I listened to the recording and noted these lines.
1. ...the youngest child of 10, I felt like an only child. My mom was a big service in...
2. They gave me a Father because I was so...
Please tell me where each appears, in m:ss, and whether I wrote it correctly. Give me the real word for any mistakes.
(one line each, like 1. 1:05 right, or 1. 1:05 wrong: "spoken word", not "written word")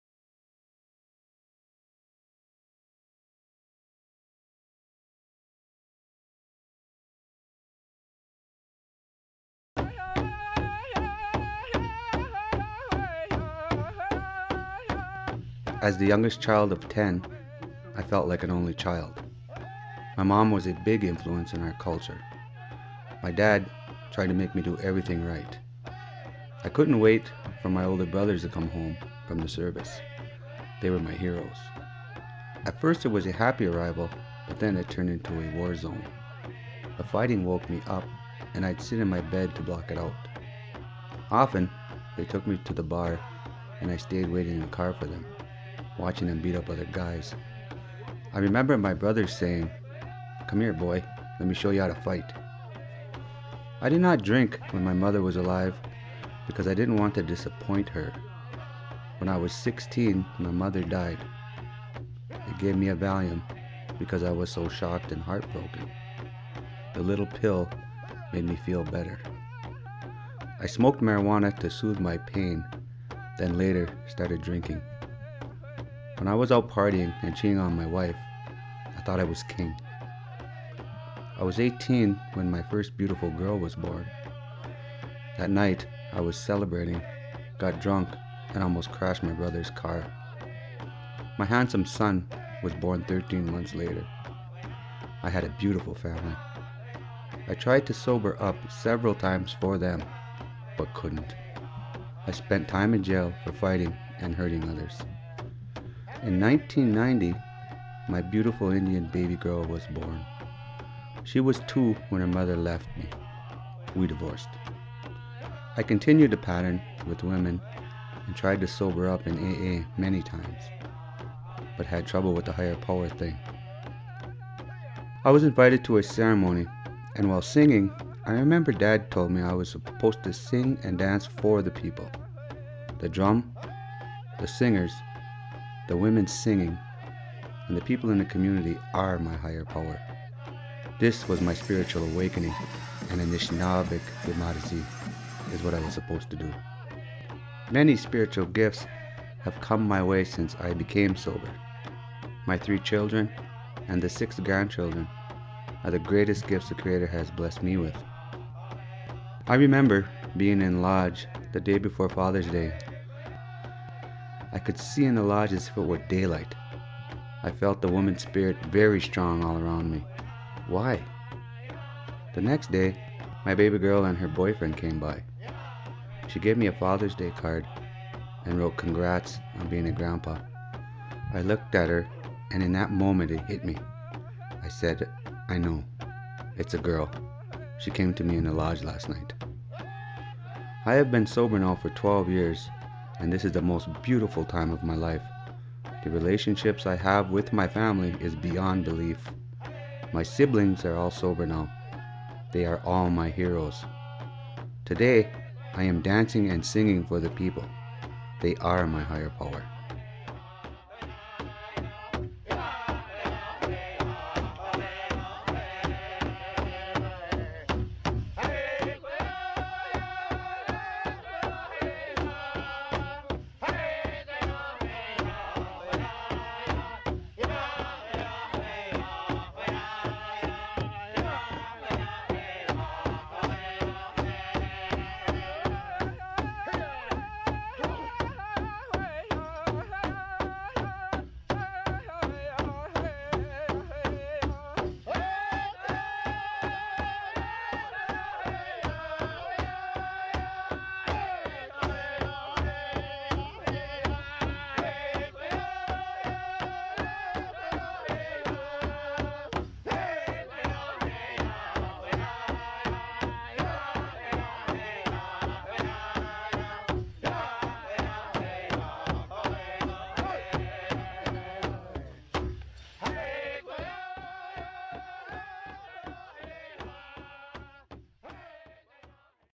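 1. 0:15 wrong: "influence", not "service"
2. 1:02 wrong: "Valium", not "Father".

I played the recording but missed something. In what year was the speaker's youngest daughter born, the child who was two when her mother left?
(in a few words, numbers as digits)
1990.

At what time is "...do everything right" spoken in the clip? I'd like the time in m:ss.
0:24.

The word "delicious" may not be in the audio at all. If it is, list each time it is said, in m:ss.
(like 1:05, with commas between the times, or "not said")
not said.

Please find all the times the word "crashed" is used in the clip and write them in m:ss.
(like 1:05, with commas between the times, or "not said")
1:28.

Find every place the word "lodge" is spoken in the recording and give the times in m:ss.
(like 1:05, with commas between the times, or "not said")
2:40, 2:45, 3:08.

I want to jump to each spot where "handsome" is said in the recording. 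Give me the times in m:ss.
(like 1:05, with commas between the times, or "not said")
1:31.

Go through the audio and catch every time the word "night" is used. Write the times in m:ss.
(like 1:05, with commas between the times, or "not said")
1:25, 3:09.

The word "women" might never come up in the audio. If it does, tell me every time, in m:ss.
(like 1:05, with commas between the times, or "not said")
1:57, 2:15.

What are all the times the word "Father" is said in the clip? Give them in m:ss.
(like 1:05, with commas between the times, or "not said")
2:42, 2:56.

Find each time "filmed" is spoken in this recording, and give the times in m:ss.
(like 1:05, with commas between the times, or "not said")
not said.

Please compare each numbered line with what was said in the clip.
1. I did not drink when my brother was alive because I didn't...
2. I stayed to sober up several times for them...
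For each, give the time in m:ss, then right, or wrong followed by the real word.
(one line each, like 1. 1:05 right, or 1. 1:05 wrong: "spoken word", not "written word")
1. 0:53 wrong: "mother", not "brother"
2. 1:37 wrong: "tried", not "stayed".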